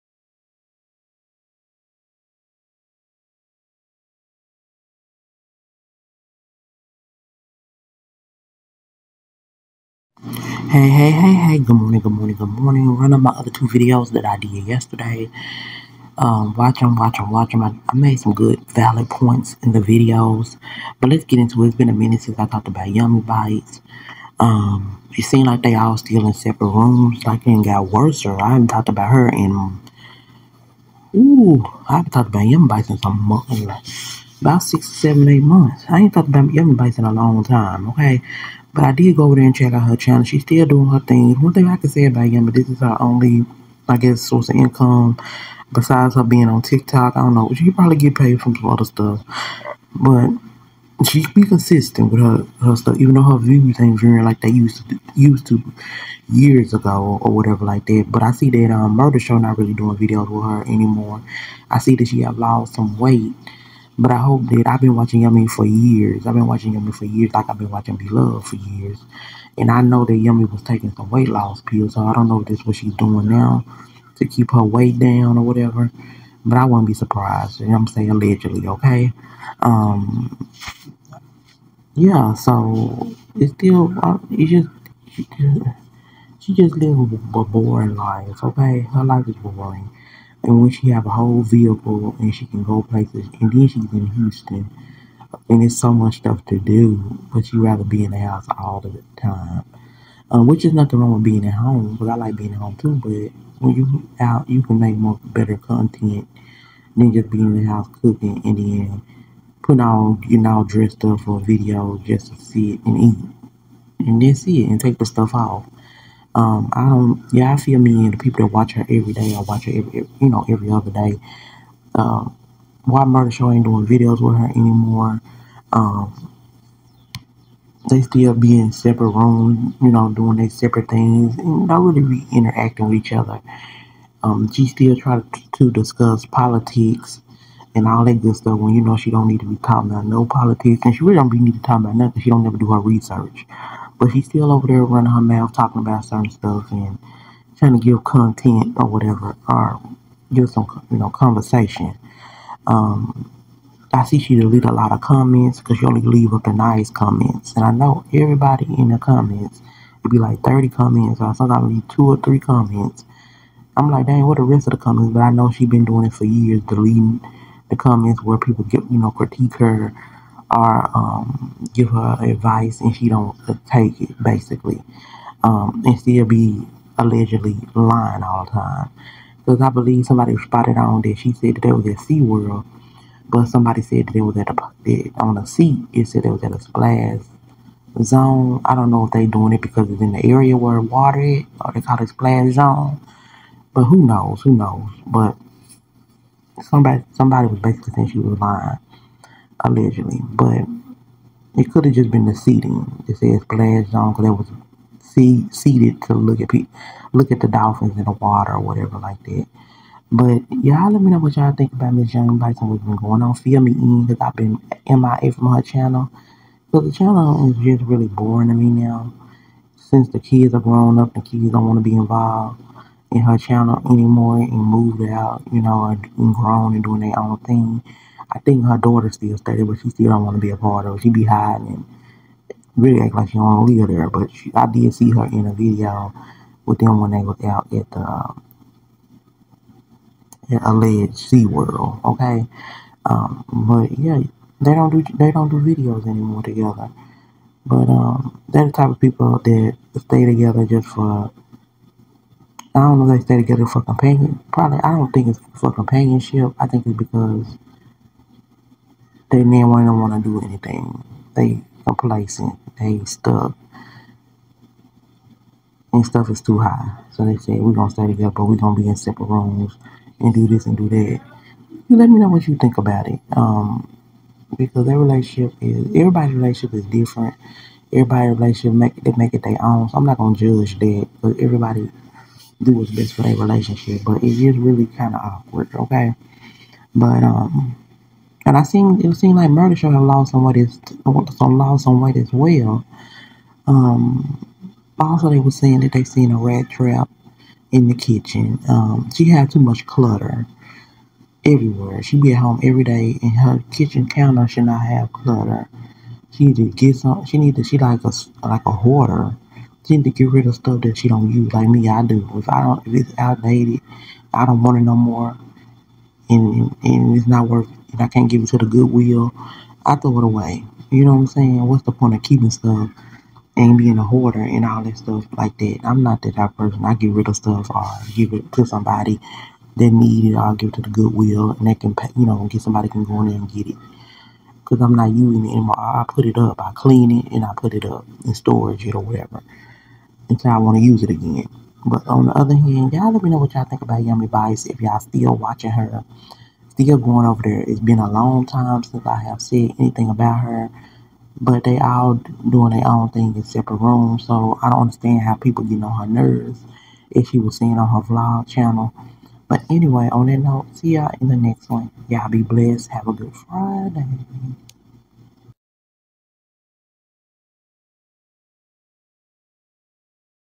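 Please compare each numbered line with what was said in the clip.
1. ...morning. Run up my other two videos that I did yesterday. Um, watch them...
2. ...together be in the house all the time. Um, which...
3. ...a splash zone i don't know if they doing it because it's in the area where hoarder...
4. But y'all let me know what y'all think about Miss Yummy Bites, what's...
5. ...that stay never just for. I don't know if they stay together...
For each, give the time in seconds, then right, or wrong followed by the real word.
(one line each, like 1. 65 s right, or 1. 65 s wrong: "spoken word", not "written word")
1. 12 s right
2. 97 s wrong: "rather", not "together"
3. 186 s wrong: "water", not "hoarder"
4. 210 s right
5. 249 s wrong: "together", not "never".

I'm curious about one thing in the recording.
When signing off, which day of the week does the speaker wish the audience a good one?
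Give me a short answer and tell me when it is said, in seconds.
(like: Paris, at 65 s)
Friday, at 363 s.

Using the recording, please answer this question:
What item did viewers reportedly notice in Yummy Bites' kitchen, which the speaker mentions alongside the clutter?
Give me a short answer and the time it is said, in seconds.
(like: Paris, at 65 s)
A rat trap, at 296 s.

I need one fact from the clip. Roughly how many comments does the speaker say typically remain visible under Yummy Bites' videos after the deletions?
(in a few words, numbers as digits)
30.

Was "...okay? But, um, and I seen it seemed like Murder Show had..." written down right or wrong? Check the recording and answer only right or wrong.
right.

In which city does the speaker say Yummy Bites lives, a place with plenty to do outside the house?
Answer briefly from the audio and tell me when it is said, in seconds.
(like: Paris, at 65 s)
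Houston, at 94 s.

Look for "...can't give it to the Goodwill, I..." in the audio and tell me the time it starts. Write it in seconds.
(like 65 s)
318 s.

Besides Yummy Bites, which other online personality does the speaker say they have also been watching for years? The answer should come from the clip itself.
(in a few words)
Beloved.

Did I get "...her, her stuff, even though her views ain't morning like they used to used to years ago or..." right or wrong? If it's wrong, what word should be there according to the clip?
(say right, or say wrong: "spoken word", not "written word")
wrong: "viewing", not "morning".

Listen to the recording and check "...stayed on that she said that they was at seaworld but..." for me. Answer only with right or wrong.
wrong.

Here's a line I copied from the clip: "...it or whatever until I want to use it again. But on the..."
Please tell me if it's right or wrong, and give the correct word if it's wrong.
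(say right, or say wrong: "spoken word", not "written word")
right.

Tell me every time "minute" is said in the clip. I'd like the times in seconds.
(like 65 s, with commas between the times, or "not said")
21 s.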